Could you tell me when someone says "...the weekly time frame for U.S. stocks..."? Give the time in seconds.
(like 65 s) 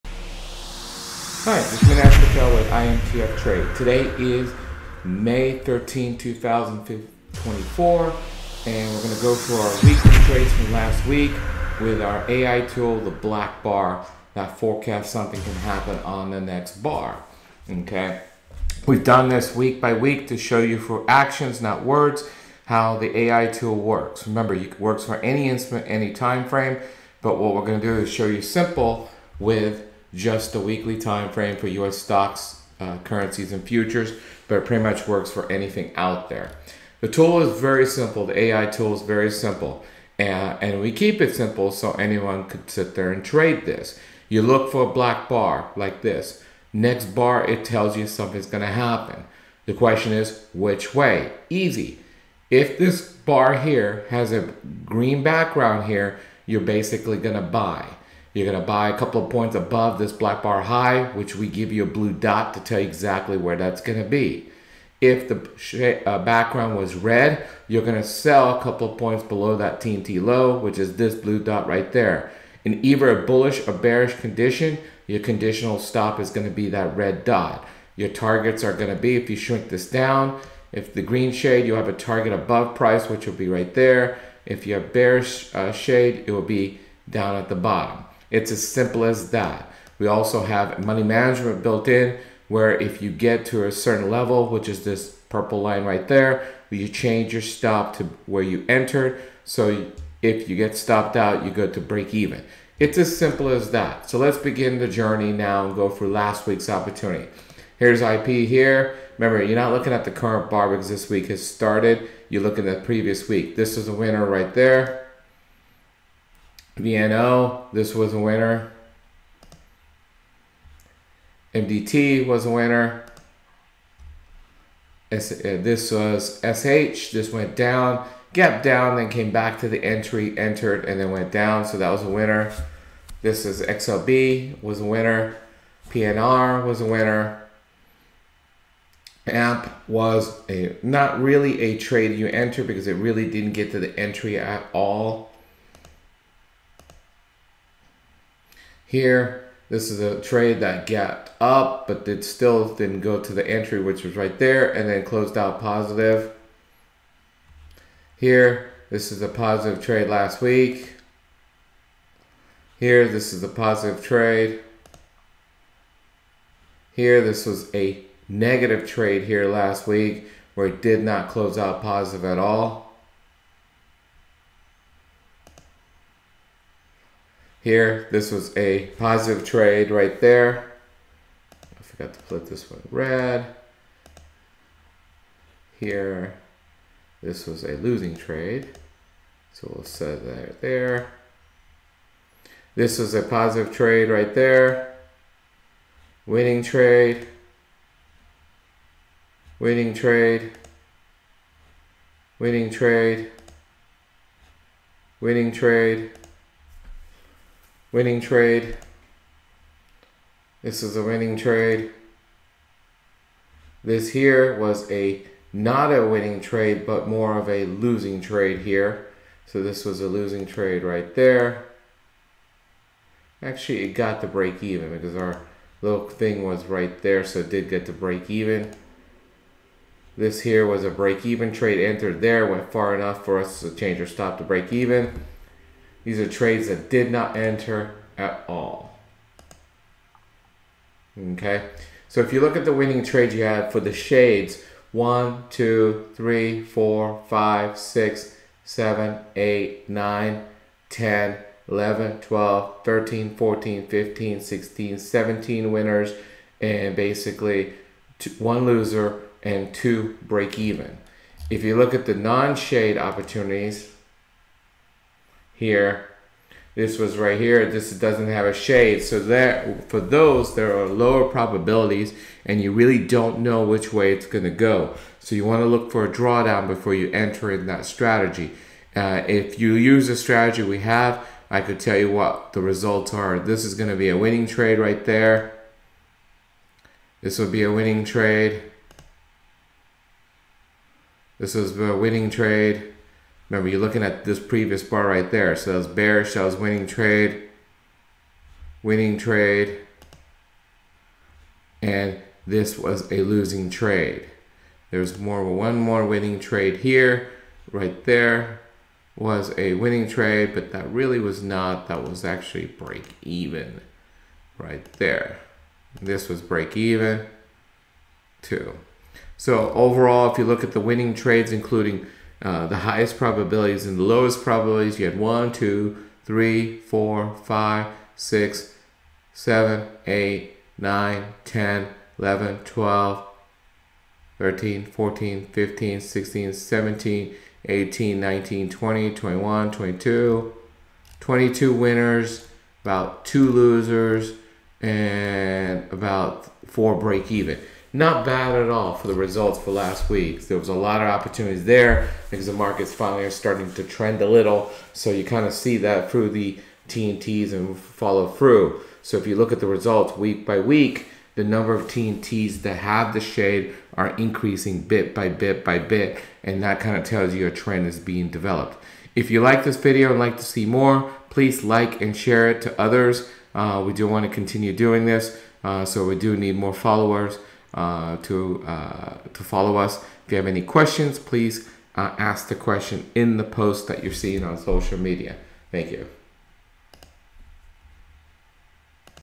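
30 s.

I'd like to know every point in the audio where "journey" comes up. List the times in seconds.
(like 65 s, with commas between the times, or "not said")
104 s.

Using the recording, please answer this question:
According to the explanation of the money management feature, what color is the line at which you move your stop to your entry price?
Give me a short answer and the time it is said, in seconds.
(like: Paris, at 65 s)
purple, at 95 s.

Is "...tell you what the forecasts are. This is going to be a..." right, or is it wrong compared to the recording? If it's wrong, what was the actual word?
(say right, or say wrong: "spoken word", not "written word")
wrong: "results", not "forecasts".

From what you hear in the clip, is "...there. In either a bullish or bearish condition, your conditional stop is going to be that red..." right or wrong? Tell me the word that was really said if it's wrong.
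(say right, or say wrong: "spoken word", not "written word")
right.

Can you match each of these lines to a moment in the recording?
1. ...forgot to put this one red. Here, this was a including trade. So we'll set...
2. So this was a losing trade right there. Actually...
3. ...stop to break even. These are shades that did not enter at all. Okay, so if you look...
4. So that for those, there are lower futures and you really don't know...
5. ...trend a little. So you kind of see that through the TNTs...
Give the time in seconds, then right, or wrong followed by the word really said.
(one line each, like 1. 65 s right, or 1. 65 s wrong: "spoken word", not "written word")
1. 181 s wrong: "losing", not "including"
2. 219 s right
3. 234 s wrong: "trades", not "shades"
4. 269 s wrong: "probabilities", not "futures"
5. 353 s right.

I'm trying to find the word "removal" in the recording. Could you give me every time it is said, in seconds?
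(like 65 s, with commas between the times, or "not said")
not said.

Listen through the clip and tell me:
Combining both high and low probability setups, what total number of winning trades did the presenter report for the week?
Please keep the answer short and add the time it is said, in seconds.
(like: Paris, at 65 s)
22, at 341 s.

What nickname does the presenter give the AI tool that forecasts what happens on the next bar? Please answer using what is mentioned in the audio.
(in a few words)
the black bar.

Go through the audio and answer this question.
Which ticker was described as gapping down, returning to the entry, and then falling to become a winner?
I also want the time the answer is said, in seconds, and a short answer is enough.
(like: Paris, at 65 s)
SH, at 126 s.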